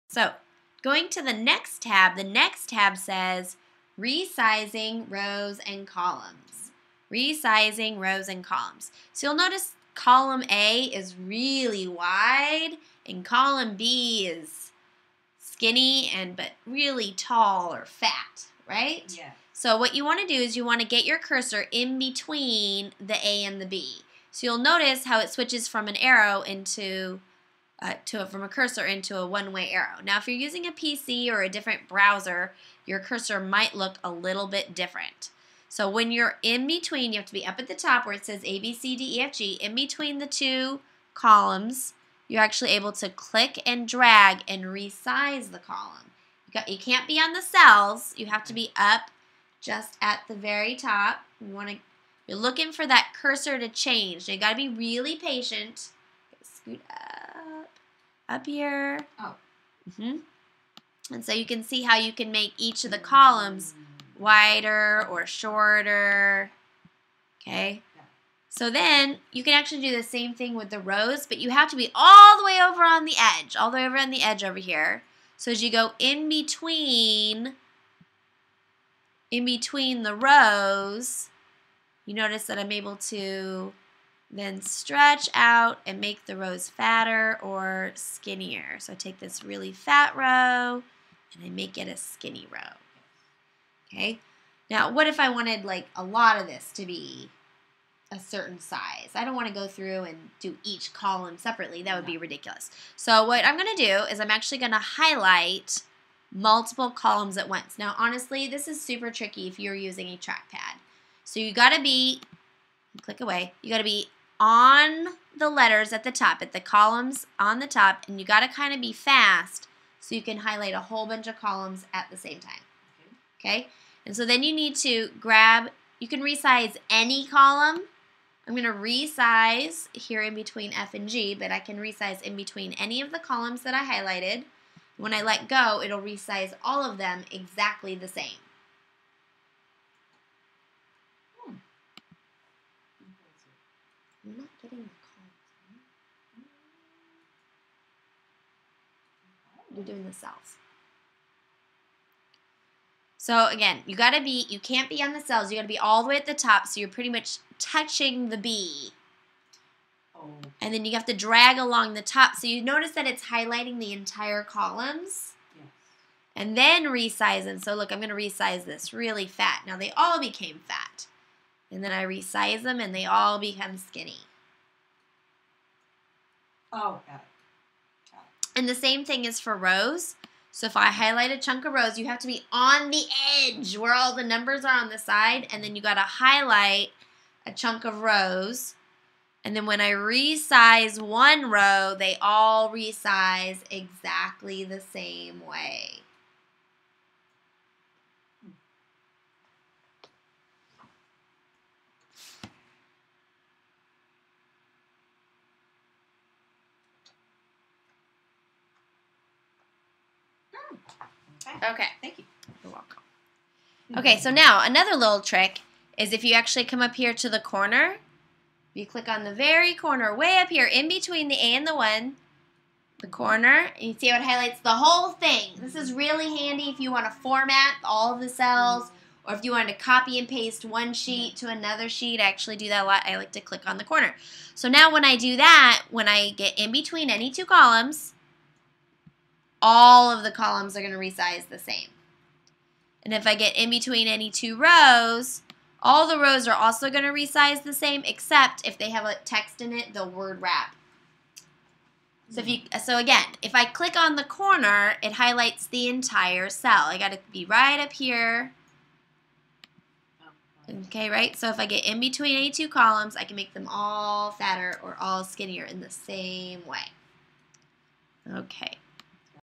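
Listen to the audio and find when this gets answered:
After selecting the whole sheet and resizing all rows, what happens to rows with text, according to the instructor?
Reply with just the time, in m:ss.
4:10.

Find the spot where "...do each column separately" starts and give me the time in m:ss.
1:40.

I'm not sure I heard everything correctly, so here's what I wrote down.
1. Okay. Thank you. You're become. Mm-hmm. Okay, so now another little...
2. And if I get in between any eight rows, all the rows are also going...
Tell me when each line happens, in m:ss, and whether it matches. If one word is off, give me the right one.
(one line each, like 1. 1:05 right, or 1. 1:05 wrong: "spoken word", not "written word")
1. 3:31 wrong: "welcome", not "become"
2. 4:03 wrong: "two", not "eight".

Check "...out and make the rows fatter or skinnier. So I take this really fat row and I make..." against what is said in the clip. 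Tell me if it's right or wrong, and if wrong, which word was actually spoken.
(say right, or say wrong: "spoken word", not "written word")
right.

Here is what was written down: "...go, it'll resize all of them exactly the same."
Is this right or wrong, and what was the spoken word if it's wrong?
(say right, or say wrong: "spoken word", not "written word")
right.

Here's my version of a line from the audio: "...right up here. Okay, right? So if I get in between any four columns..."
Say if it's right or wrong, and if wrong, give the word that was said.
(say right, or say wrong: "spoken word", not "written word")
wrong: "two", not "four".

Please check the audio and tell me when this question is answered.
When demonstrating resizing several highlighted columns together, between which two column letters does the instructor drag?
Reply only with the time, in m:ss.
2:10.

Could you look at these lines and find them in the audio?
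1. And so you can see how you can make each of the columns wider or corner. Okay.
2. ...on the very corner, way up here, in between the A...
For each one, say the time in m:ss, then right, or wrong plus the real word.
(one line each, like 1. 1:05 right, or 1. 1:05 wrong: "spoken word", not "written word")
1. 1:01 wrong: "shorter", not "corner"
2. 3:39 right.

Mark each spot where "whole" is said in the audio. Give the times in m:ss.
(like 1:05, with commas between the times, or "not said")
2:00, 3:44.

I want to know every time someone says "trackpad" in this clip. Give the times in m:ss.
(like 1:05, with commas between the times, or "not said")
1:50.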